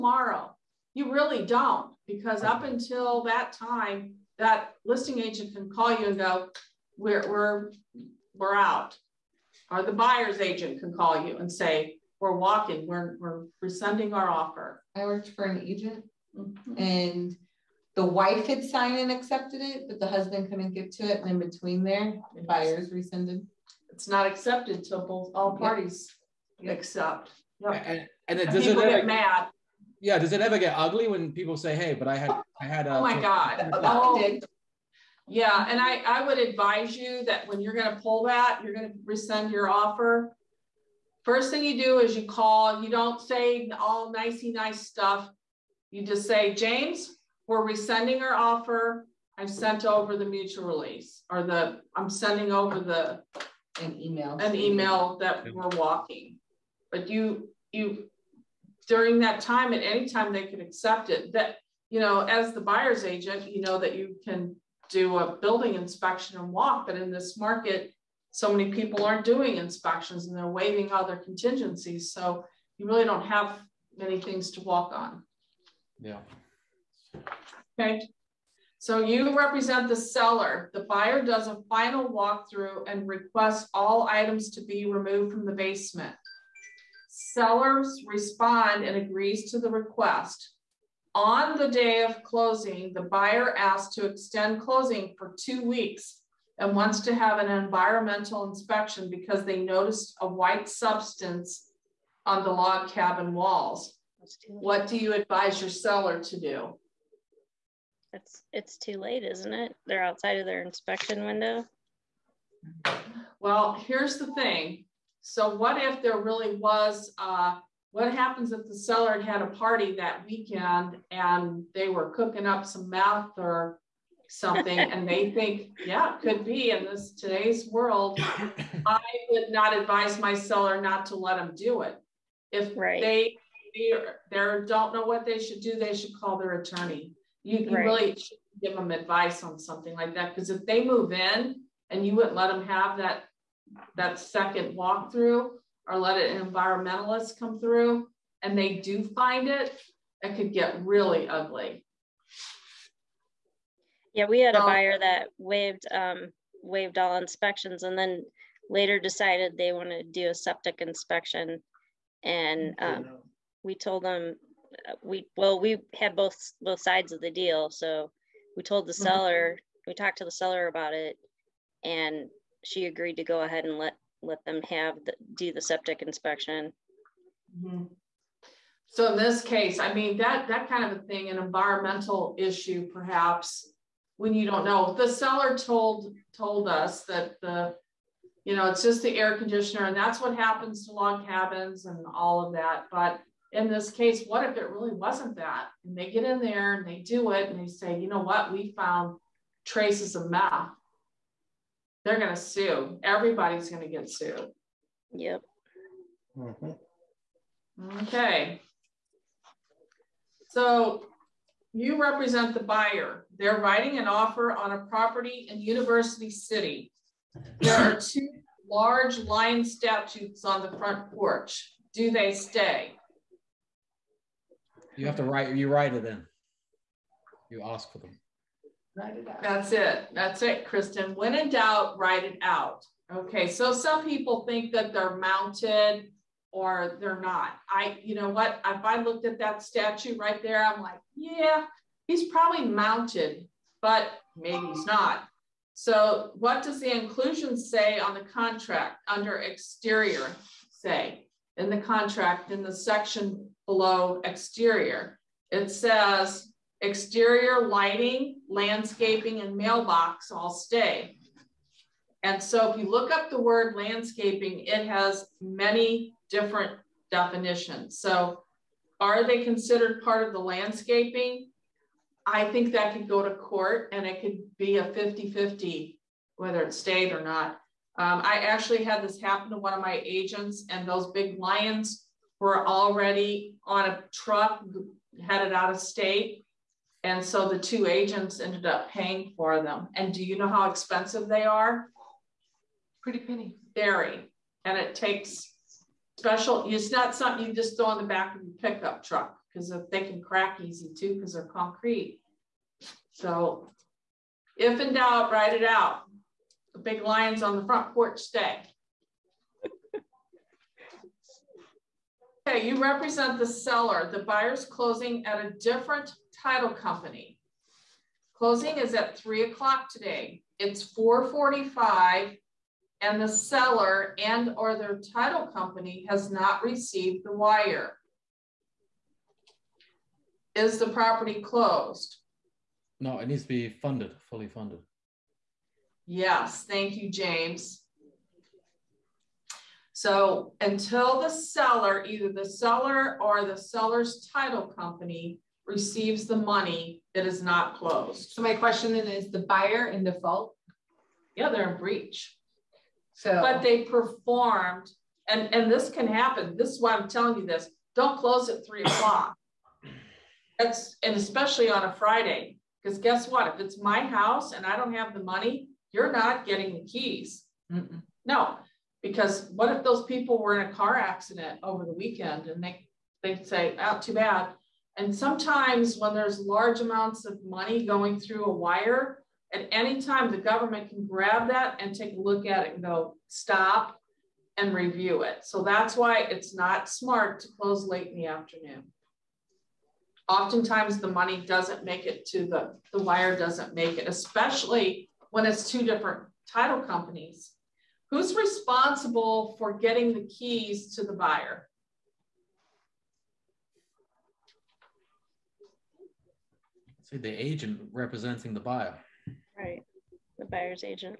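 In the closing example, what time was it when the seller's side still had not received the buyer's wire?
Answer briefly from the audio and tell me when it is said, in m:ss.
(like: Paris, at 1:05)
4:45, at 5:20.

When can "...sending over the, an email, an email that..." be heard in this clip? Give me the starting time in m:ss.
0:52.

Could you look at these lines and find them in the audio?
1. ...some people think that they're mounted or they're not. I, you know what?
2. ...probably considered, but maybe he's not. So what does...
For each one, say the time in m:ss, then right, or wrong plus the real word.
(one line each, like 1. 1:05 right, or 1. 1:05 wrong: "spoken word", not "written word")
1. 3:53 right
2. 4:02 wrong: "mounted", not "considered".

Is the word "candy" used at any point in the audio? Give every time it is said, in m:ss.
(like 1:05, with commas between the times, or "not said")
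not said.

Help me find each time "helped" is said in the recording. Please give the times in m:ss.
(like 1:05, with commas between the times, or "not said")
not said.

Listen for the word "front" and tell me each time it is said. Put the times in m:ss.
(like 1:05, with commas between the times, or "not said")
3:40, 5:07.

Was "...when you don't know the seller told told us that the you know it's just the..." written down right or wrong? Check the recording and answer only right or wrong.
right.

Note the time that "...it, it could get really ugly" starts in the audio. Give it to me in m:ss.
2:29.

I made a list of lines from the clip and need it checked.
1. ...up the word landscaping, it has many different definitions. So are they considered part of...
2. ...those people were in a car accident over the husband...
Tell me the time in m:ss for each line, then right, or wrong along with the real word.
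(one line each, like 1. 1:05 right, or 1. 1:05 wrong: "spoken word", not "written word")
1. 4:23 right
2. 6:09 wrong: "weekend", not "husband".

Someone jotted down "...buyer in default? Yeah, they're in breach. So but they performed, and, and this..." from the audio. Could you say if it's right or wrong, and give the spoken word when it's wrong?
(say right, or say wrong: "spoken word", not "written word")
right.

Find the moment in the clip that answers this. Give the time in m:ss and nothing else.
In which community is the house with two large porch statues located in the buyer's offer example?
3:35.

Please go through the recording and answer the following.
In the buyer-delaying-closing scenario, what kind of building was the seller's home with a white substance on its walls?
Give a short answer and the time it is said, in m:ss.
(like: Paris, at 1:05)
Log cabin, at 1:42.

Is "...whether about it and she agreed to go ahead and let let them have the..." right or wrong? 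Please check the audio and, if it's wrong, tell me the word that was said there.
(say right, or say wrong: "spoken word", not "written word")
wrong: "seller", not "whether".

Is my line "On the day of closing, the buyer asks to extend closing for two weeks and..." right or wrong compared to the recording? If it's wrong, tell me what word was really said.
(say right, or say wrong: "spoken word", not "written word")
right.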